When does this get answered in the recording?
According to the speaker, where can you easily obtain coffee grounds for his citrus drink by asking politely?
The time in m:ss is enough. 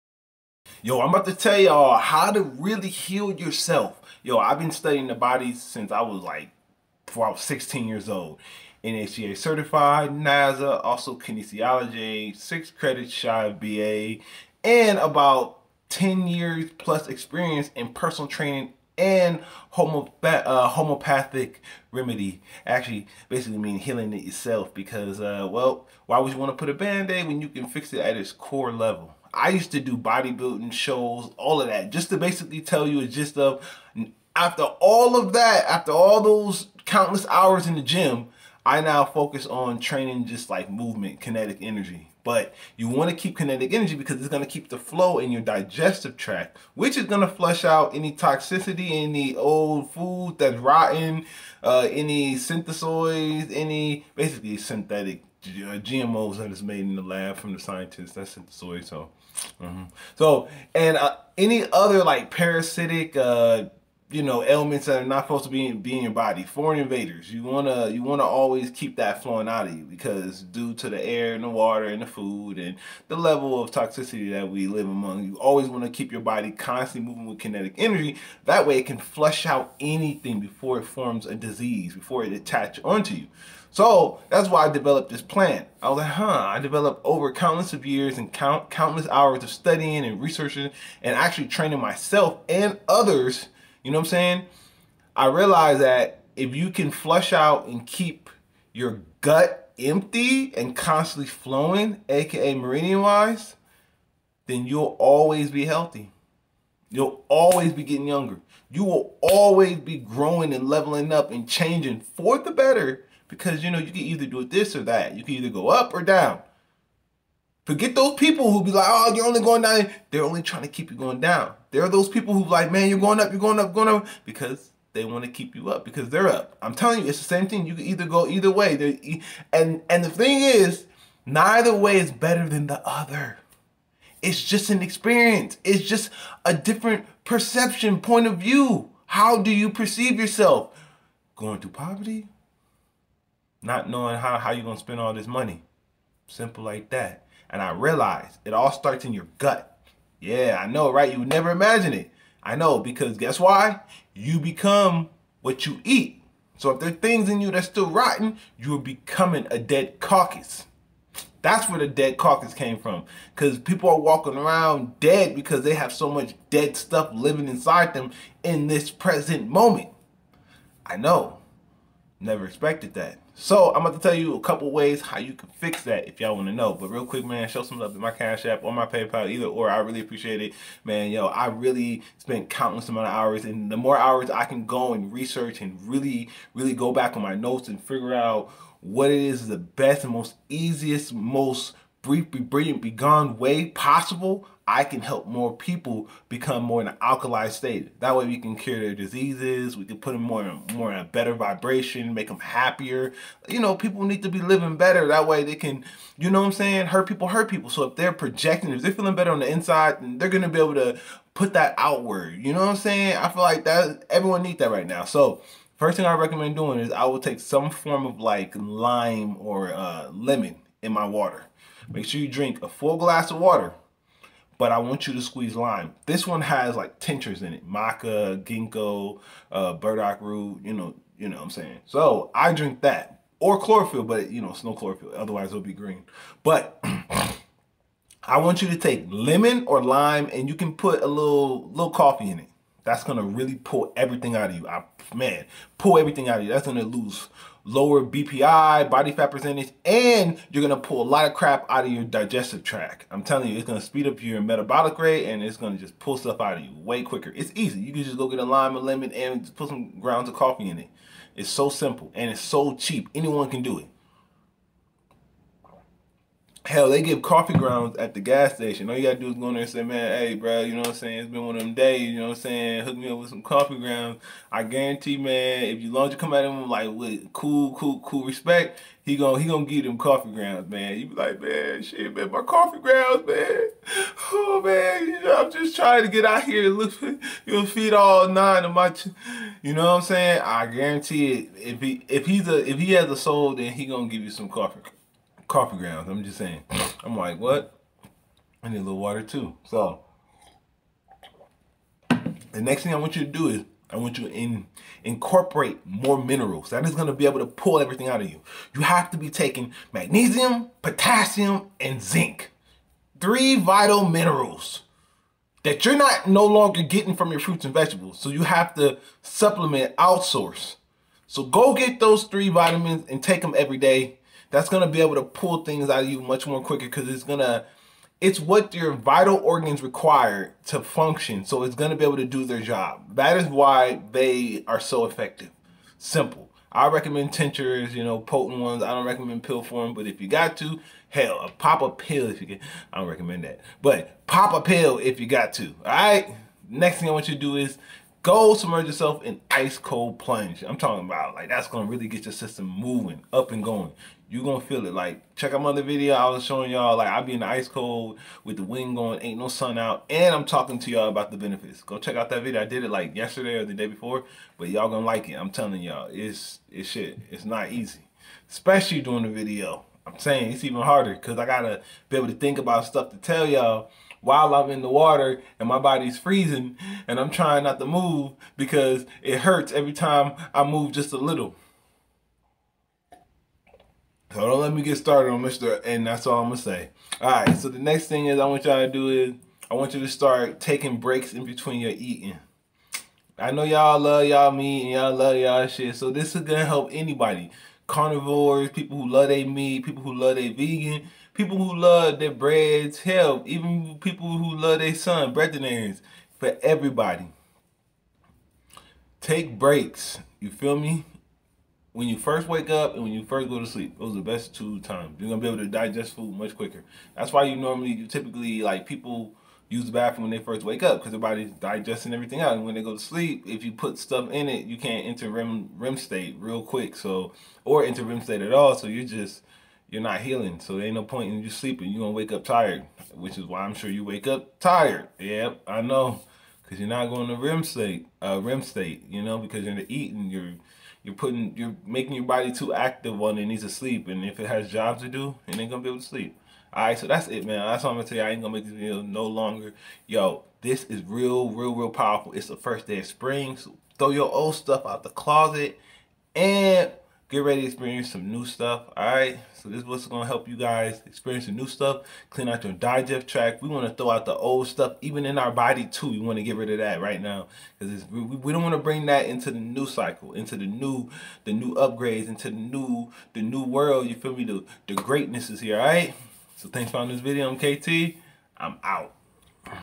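4:28.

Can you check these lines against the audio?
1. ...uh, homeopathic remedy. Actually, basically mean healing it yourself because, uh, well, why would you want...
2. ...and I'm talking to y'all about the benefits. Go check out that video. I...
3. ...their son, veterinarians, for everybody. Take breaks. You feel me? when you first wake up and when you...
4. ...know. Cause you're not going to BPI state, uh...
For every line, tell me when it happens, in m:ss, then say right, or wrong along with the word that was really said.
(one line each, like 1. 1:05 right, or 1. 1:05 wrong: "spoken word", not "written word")
1. 0:20 right
2. 6:00 right
3. 6:44 right
4. 7:15 wrong: "REM", not "BPI".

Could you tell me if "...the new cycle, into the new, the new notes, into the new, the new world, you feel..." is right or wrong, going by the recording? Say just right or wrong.
wrong.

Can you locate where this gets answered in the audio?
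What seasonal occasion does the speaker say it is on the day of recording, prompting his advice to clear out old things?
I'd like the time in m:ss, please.
7:32.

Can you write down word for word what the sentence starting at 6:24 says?
So don't let me get started on Mr.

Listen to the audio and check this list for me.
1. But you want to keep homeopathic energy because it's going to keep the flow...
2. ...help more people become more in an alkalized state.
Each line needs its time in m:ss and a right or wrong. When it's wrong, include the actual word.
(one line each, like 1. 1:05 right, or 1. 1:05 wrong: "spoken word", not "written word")
1. 0:42 wrong: "kinetic", not "homeopathic"
2. 3:15 right.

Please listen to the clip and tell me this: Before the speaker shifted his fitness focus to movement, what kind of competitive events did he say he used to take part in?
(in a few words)
bodybuilding shows.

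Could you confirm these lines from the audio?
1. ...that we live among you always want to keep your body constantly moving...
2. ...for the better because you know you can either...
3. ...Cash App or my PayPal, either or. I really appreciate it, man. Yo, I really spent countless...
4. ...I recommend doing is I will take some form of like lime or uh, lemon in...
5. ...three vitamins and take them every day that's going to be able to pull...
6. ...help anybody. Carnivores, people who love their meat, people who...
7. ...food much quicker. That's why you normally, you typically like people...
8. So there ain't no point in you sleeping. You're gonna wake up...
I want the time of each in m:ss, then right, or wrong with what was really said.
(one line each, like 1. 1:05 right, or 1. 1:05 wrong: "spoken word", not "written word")
1. 1:14 right
2. 1:52 right
3. 2:58 right
4. 3:36 right
5. 5:22 right
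6. 6:36 right
7. 6:56 right
8. 7:10 right.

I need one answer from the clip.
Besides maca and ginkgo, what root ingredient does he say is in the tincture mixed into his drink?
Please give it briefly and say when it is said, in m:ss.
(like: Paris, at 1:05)
burdock root, at 3:49.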